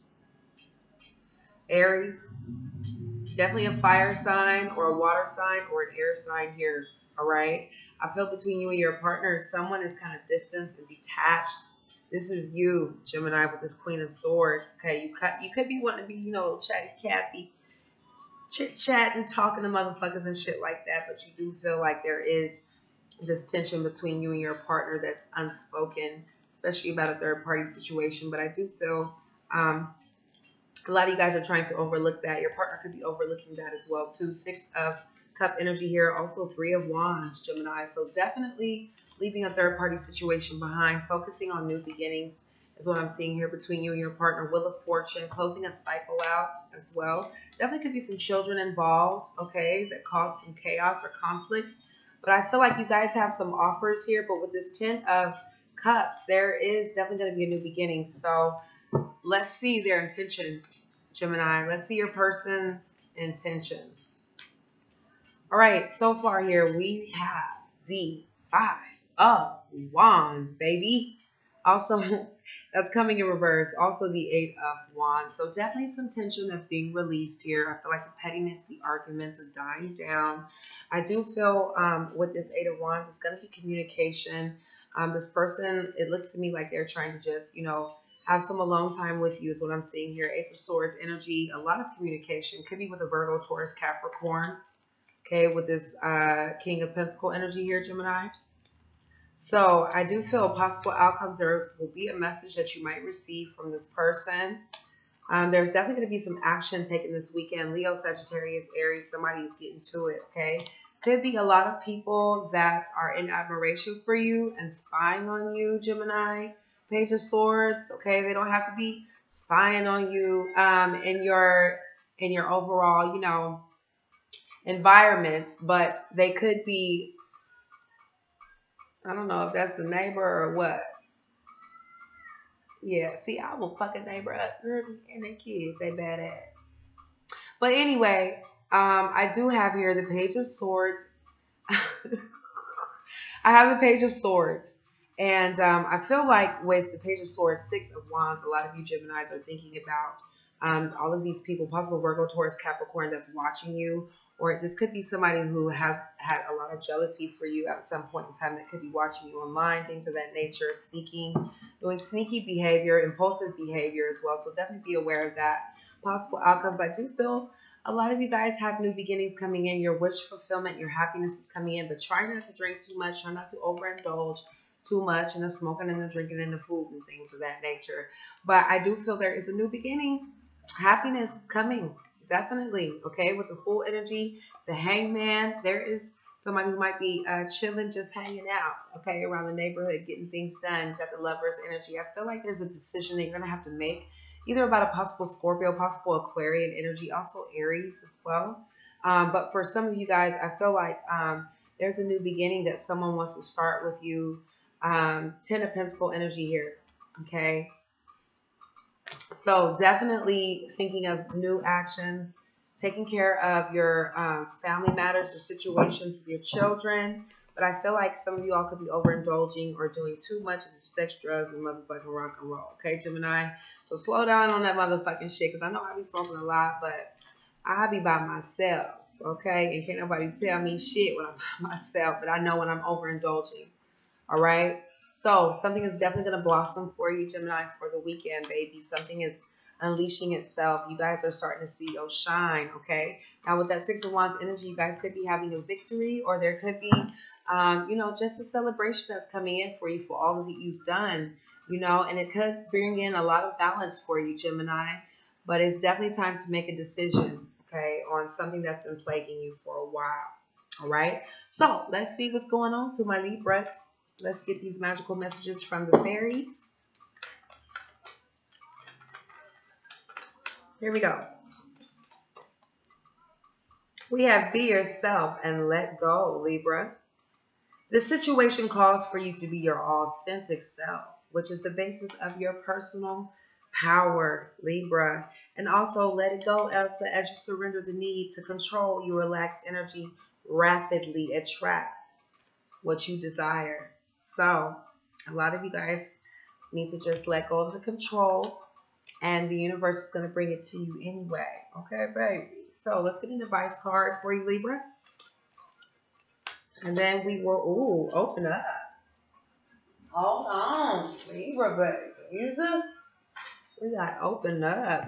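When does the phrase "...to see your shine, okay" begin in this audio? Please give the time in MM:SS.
04:01.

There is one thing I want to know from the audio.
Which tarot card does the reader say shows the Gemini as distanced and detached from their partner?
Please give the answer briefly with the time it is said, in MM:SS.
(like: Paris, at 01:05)
Queen of Swords, at 00:13.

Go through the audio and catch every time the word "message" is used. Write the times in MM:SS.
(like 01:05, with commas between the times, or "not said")
01:42, 04:25.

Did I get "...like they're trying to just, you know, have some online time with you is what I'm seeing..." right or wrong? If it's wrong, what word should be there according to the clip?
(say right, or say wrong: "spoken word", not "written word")
wrong: "alone", not "online".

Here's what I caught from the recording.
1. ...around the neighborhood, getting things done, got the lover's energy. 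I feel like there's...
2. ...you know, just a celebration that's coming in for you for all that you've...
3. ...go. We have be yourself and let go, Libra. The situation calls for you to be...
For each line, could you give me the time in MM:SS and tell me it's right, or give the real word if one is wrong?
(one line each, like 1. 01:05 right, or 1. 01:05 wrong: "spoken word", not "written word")
1. 03:09 right
2. 04:07 right
3. 04:31 right.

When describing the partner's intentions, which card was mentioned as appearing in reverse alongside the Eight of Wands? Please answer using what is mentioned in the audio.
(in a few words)
Five of Wands.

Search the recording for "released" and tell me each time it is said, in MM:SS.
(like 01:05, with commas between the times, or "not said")
01:16.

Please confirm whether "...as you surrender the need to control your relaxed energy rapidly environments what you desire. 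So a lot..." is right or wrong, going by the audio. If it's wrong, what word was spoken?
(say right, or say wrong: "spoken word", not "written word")
wrong: "attracts", not "environments".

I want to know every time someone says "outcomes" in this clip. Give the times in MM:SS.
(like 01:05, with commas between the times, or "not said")
01:40, 02:46.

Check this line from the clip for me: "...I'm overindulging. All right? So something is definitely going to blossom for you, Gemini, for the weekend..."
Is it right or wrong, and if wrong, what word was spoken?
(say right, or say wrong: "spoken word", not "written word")
right.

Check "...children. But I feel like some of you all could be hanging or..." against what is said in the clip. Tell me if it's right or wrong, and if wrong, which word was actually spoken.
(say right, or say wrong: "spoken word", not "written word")
wrong: "overindulging", not "hanging".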